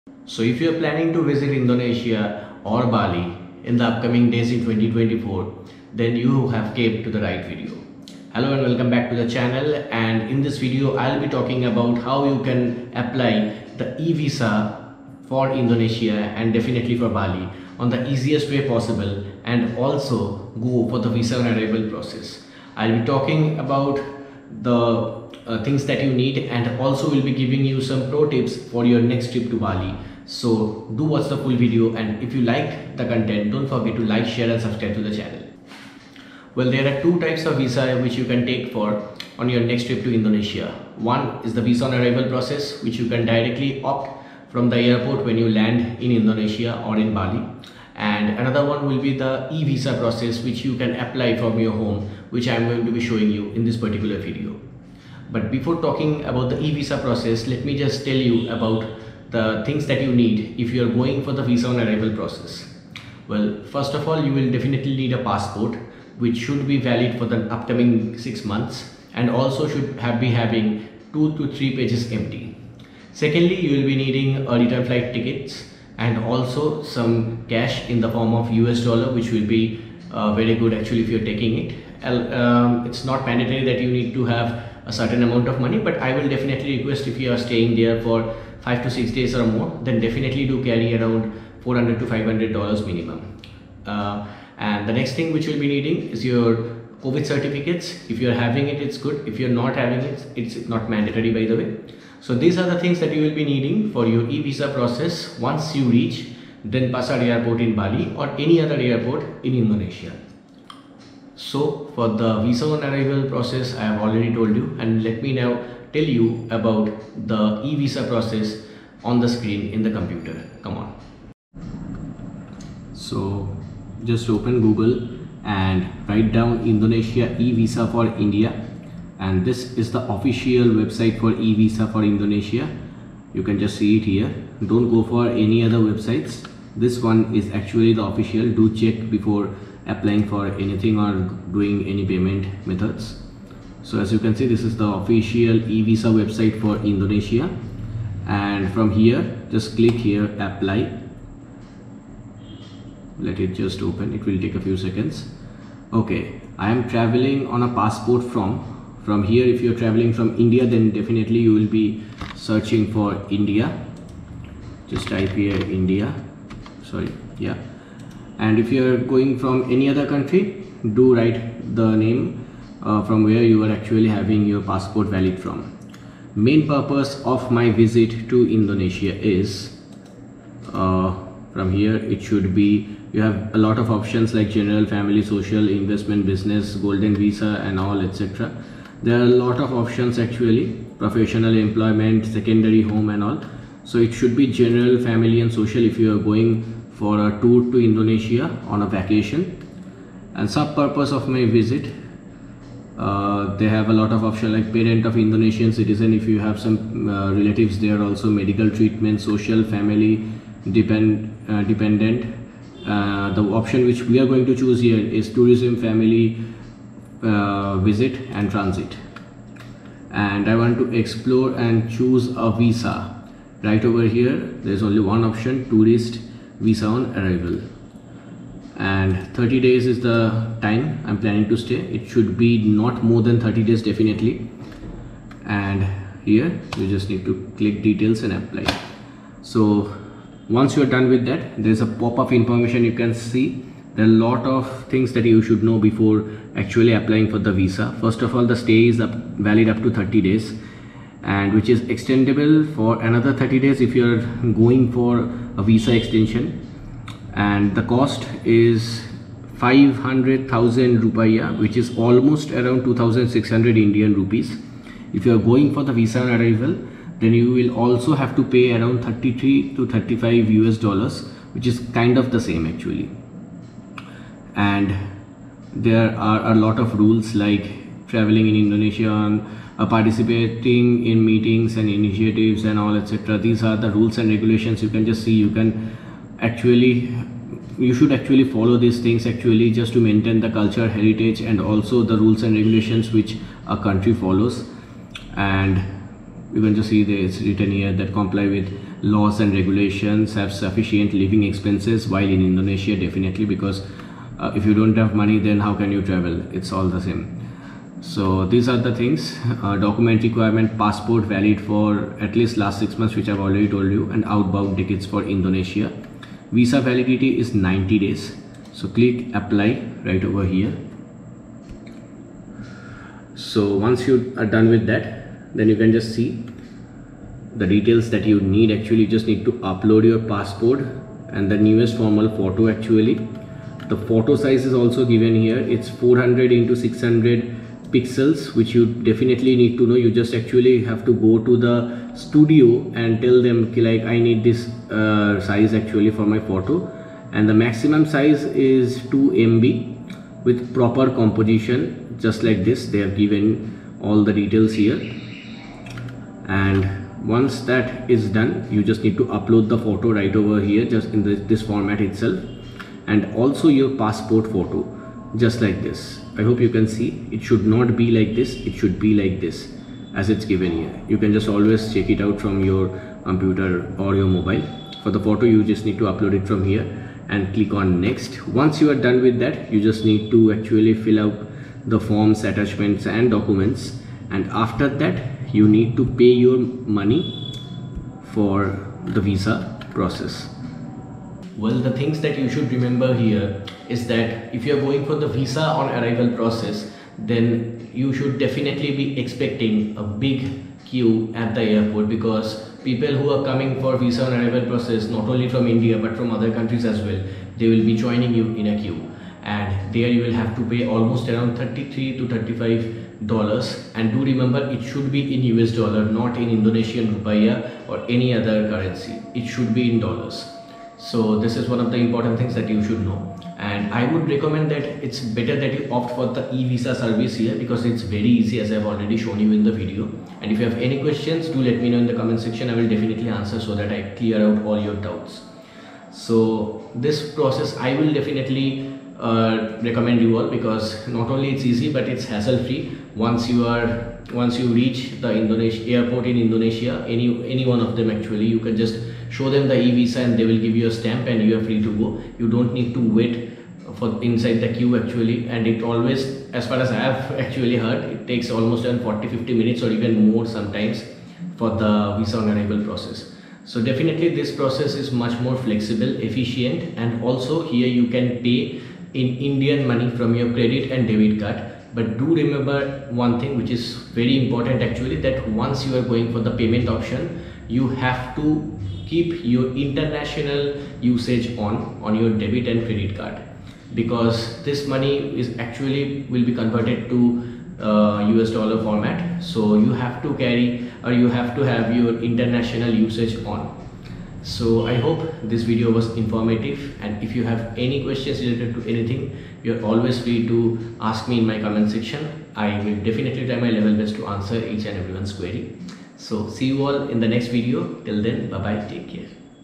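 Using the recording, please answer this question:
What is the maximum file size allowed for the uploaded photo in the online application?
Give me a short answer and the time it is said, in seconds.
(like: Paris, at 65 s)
2 MB, at 349 s.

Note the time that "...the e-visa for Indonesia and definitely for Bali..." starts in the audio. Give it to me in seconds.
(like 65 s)
13 s.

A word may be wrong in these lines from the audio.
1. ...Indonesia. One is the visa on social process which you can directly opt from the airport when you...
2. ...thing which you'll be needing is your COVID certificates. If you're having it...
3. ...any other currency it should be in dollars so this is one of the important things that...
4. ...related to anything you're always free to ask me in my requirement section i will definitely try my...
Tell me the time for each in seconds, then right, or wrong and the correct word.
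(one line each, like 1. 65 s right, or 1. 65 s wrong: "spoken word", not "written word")
1. 40 s wrong: "arrival", not "social"
2. 95 s right
3. 418 s right
4. 498 s wrong: "comment", not "requirement".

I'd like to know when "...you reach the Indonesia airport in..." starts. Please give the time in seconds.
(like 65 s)
444 s.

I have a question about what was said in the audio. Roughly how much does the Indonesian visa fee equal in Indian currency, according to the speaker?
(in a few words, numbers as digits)
2600 Indian rupees.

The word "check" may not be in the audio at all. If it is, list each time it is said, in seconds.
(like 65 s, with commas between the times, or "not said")
138 s, 371 s.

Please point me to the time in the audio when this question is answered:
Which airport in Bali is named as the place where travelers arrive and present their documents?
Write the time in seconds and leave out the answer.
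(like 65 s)
106 s.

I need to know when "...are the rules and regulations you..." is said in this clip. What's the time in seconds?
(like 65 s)
283 s.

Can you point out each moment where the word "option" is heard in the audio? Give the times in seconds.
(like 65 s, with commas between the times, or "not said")
183 s, 189 s, 204 s, 213 s, 225 s, 476 s.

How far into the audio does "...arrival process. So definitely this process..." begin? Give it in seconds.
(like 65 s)
462 s.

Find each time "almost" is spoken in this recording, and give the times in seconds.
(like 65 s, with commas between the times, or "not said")
261 s, 410 s, 458 s.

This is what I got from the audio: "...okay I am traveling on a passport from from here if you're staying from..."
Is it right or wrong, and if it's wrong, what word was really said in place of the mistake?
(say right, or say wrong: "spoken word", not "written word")
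wrong: "traveling", not "staying".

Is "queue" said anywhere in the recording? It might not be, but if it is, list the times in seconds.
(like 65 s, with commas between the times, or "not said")
400 s, 408 s, 454 s.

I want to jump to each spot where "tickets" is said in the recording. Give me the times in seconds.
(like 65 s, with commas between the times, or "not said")
75 s, 314 s.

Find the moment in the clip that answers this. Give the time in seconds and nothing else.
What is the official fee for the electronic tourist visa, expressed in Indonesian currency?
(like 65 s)
259 s.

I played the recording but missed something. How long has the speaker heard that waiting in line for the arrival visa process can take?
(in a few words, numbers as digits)
40-50 minutes.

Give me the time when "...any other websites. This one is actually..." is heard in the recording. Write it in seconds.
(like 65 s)
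135 s.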